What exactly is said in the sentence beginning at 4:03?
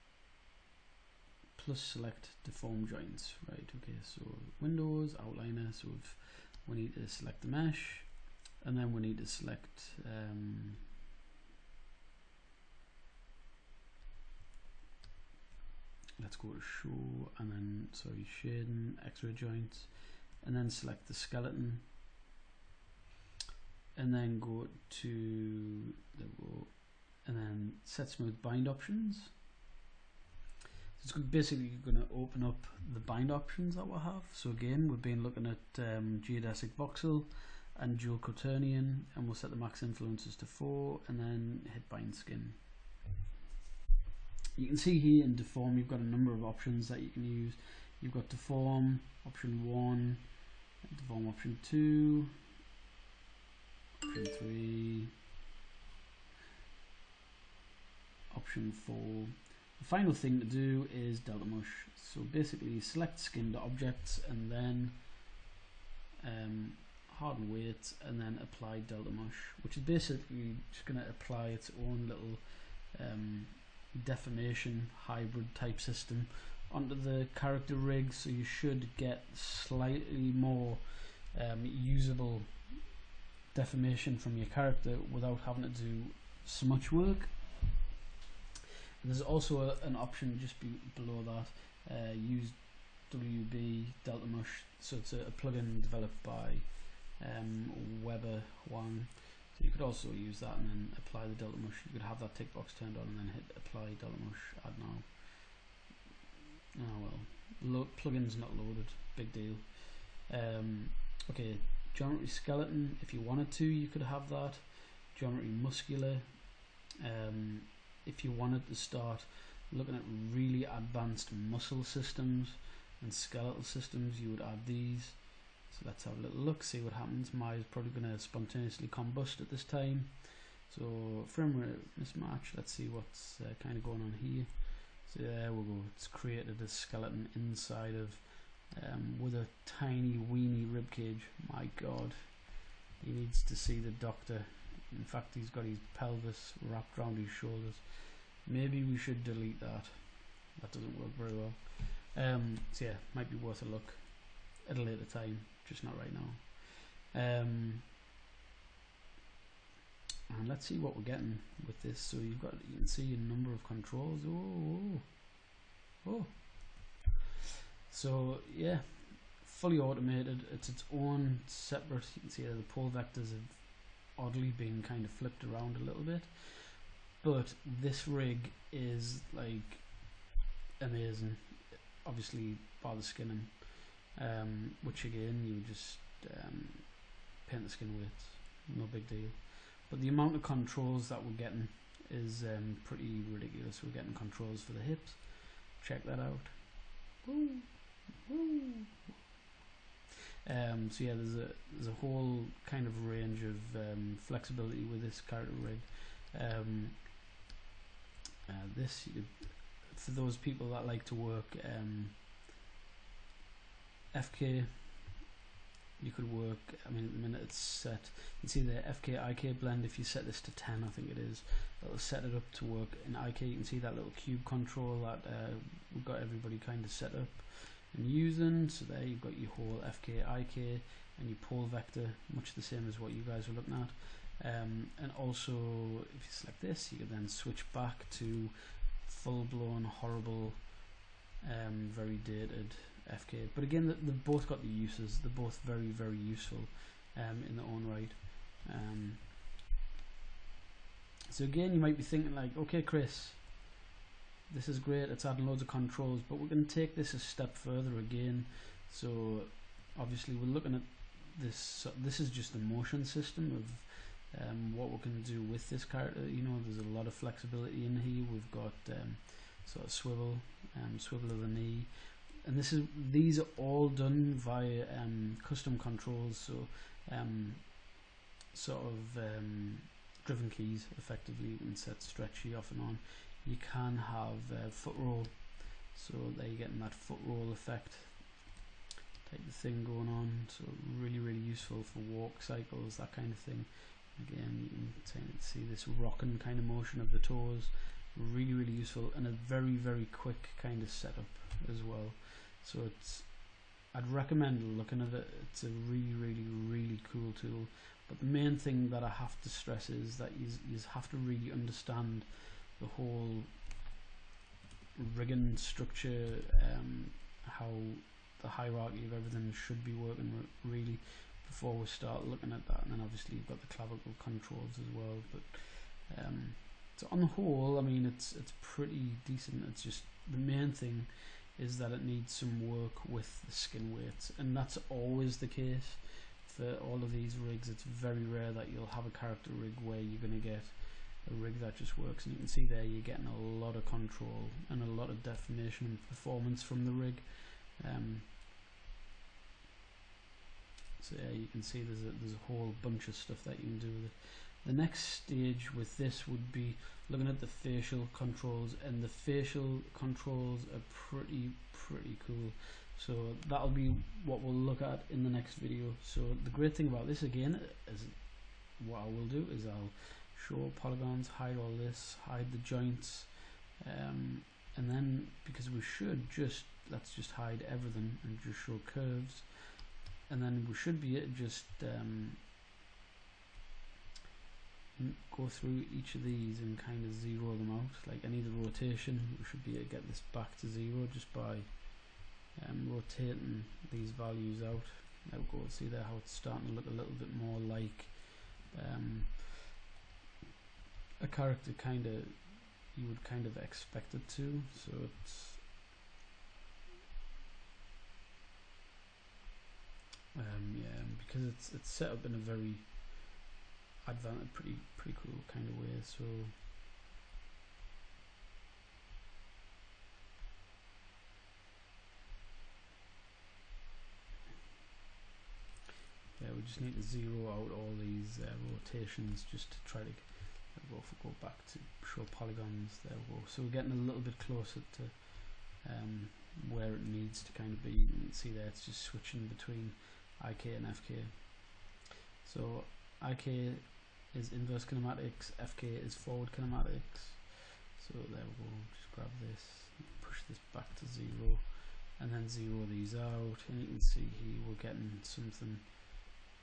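But again, they've both got the uses.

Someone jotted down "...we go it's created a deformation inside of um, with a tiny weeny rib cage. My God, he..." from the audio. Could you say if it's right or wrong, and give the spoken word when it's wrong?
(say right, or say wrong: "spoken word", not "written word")
wrong: "skeleton", not "deformation".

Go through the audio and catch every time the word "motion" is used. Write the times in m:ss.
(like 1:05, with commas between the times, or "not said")
4:22, 4:56.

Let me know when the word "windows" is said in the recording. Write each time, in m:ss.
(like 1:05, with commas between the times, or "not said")
0:04.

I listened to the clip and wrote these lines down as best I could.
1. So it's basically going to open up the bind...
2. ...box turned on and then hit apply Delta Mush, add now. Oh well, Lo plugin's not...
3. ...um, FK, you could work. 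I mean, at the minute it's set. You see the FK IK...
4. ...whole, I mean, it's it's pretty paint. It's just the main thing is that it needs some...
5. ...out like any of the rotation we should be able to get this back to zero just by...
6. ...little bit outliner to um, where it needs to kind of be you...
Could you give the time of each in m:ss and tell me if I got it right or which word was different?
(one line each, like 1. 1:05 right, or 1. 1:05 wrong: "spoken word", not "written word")
1. 0:31 right
2. 1:42 right
3. 3:31 right
4. 5:27 wrong: "decent", not "paint"
5. 6:27 right
6. 7:14 wrong: "closer", not "outliner".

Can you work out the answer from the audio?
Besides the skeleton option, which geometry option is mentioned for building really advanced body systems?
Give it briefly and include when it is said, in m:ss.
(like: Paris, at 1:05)
geometry muscular, at 1:55.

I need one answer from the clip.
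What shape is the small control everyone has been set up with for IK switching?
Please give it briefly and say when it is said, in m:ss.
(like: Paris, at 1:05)
cube, at 3:44.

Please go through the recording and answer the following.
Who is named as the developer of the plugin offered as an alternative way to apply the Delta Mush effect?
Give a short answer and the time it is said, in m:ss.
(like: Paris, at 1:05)
Webber Huang, at 1:38.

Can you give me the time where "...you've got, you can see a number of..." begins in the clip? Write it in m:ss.
2:42.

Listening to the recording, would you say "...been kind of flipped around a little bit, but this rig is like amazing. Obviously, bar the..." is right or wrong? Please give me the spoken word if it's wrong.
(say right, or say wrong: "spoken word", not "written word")
right.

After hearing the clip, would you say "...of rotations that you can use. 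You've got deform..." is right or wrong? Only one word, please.
wrong.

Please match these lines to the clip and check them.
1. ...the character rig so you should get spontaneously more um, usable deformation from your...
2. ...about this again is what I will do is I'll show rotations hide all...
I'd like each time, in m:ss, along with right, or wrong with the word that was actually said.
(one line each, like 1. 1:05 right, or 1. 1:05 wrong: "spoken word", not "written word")
1. 1:16 wrong: "slightly", not "spontaneously"
2. 6:06 wrong: "polygons", not "rotations".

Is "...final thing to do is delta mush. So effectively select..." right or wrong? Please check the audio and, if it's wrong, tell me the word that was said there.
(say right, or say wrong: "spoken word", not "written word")
wrong: "basically", not "effectively".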